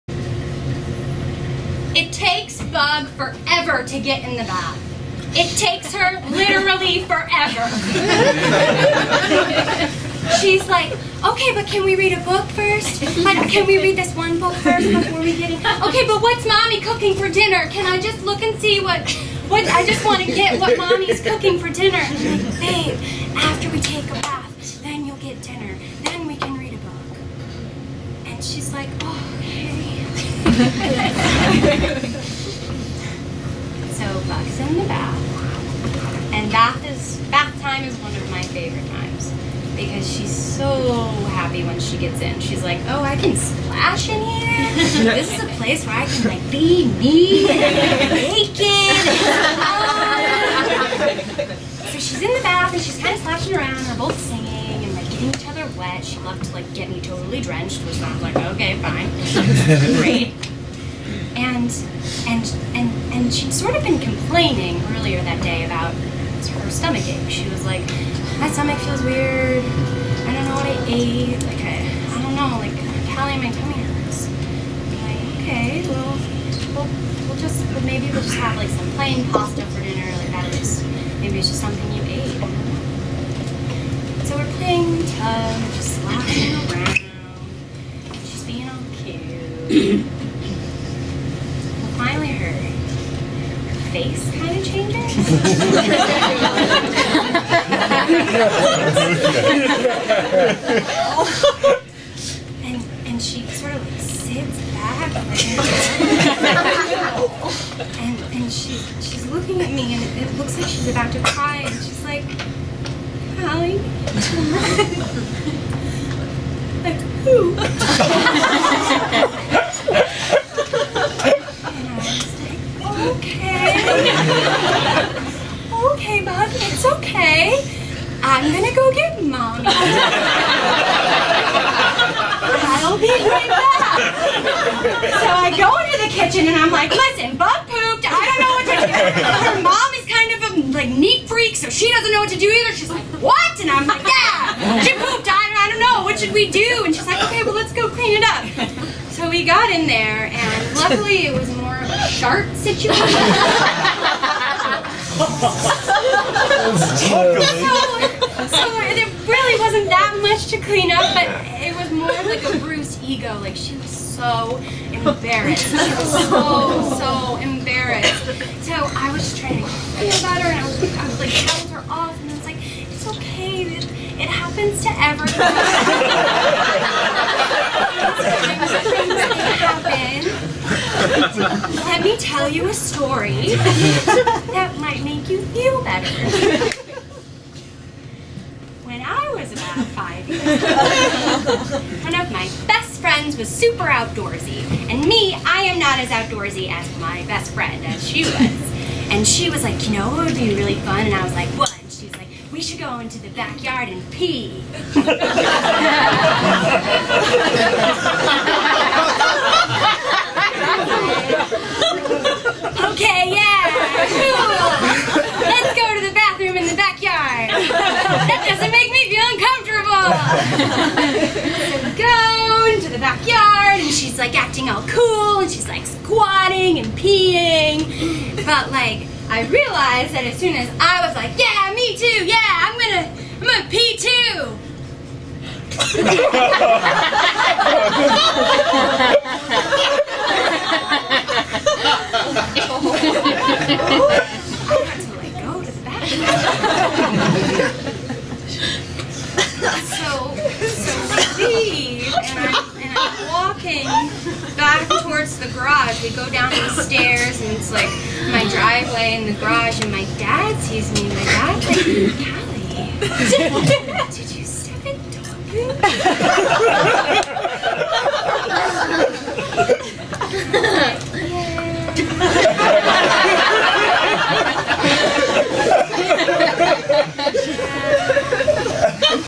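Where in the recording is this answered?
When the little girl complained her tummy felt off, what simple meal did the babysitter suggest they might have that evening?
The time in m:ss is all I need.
1:18.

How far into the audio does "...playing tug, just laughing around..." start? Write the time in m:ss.
1:24.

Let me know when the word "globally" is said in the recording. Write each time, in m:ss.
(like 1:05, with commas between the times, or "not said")
not said.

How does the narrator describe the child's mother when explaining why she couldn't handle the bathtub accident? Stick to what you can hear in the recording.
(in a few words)
neat freak.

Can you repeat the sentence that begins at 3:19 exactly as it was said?
And she was like, you know what would be really fun?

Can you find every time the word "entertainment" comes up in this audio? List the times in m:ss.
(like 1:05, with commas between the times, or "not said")
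not said.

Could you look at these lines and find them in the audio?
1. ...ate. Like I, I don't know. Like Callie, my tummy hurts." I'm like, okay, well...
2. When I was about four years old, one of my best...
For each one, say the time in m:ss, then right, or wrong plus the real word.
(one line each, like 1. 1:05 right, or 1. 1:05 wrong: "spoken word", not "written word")
1. 1:10 right
2. 3:08 wrong: "five", not "four".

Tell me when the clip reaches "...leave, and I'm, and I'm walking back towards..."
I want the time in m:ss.
4:11.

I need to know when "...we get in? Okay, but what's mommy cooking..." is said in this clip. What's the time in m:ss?
0:15.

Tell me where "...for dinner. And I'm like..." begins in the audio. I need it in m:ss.
0:21.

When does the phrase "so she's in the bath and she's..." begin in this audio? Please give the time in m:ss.
0:51.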